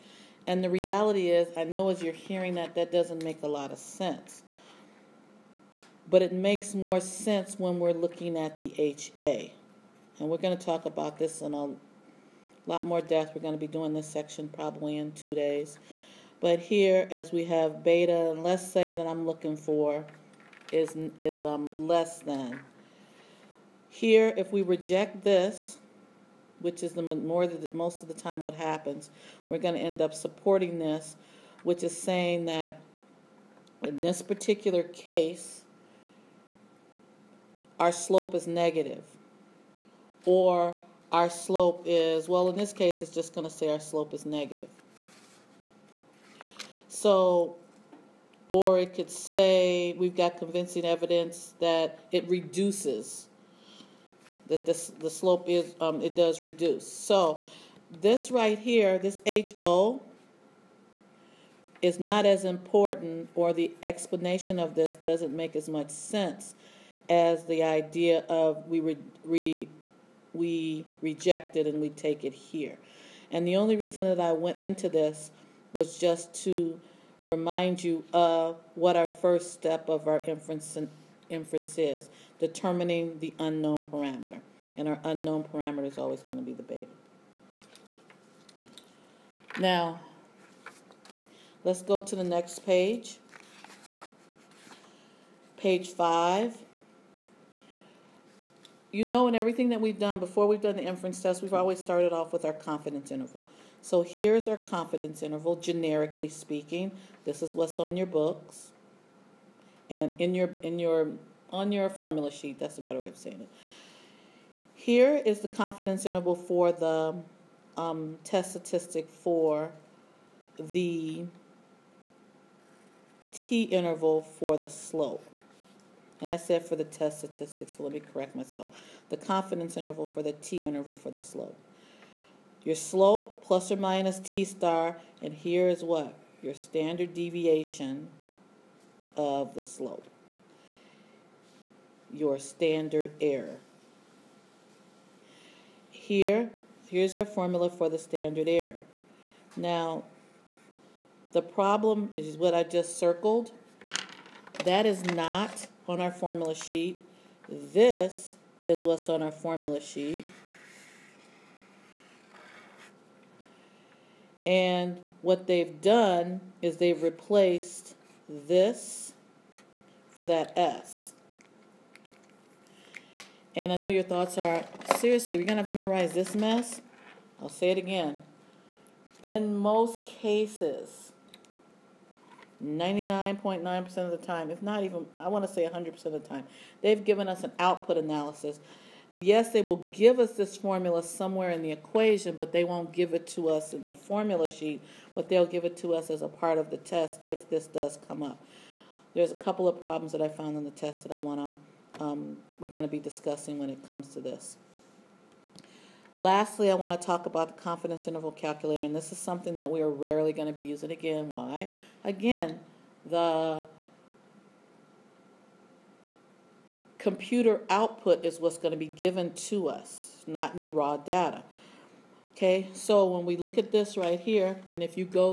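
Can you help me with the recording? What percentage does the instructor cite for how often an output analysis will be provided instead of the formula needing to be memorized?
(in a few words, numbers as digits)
99.9%.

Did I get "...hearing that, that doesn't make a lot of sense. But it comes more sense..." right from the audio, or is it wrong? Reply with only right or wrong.
wrong.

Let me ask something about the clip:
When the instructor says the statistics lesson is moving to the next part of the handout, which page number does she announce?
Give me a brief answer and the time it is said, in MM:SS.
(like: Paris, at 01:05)
Page 5, at 01:35.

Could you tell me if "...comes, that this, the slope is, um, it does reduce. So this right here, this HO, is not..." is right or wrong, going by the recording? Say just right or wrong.
wrong.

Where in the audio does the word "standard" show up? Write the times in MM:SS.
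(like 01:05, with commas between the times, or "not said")
02:16, 02:22, 02:27.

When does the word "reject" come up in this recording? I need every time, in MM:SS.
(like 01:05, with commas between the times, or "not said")
00:24, 01:11.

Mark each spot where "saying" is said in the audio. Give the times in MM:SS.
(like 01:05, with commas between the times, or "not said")
00:31, 01:53.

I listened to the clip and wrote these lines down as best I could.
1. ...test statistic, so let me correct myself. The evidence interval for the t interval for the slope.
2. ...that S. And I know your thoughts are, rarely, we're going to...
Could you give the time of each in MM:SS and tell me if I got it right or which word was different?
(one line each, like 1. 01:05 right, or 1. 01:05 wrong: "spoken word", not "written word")
1. 02:06 wrong: "confidence", not "evidence"
2. 02:50 wrong: "seriously", not "rarely".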